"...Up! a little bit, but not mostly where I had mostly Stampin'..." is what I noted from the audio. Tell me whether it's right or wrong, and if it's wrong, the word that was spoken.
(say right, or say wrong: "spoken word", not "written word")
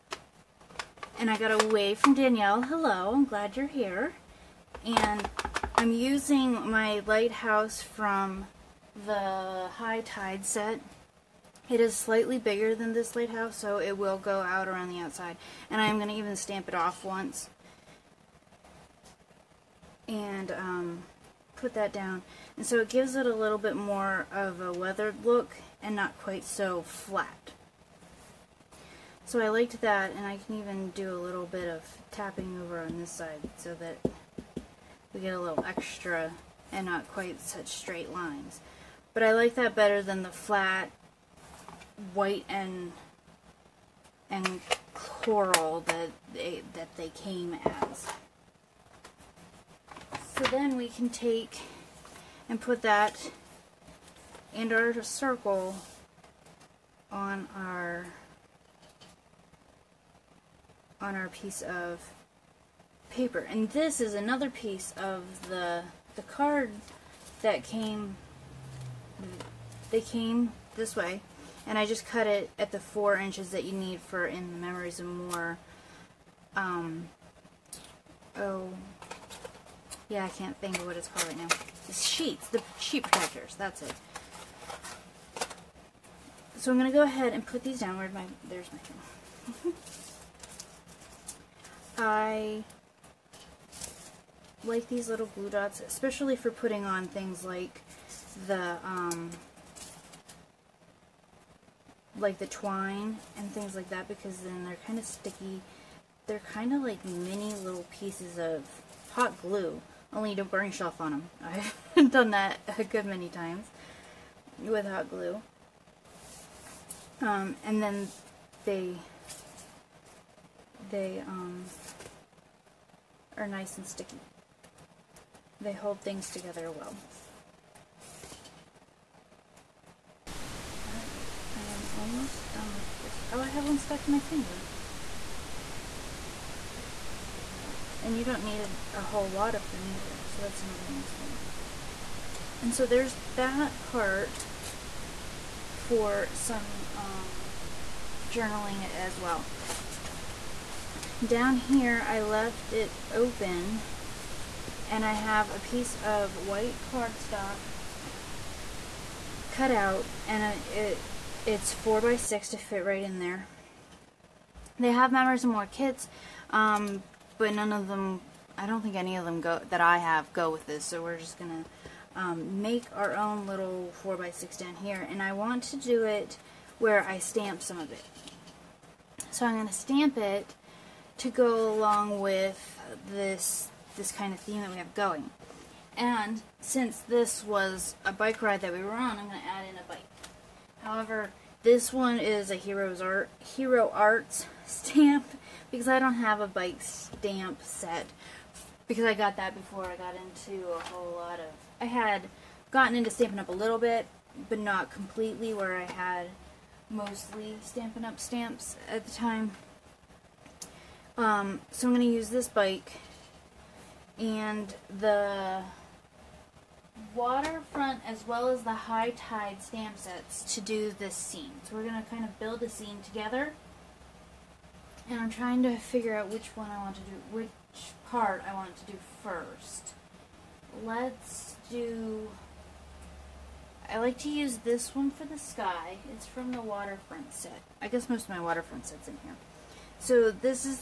wrong: "completely", not "mostly".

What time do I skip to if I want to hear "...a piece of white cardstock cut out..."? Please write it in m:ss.
2:35.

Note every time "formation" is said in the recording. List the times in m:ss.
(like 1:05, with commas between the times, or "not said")
not said.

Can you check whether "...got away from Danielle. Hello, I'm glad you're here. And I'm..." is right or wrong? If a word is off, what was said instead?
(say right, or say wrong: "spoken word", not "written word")
right.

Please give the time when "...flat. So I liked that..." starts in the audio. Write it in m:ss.
0:26.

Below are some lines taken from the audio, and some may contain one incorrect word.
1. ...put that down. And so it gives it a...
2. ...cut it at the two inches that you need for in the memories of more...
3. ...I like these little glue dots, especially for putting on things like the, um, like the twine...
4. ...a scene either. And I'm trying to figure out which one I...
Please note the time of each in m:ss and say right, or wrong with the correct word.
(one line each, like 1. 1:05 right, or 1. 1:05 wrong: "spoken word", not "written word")
1. 0:21 right
2. 1:12 wrong: "four", not "two"
3. 1:31 right
4. 3:42 wrong: "together", not "either".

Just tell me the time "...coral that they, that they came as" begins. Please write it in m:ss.
0:44.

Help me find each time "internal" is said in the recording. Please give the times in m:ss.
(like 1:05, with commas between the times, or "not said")
not said.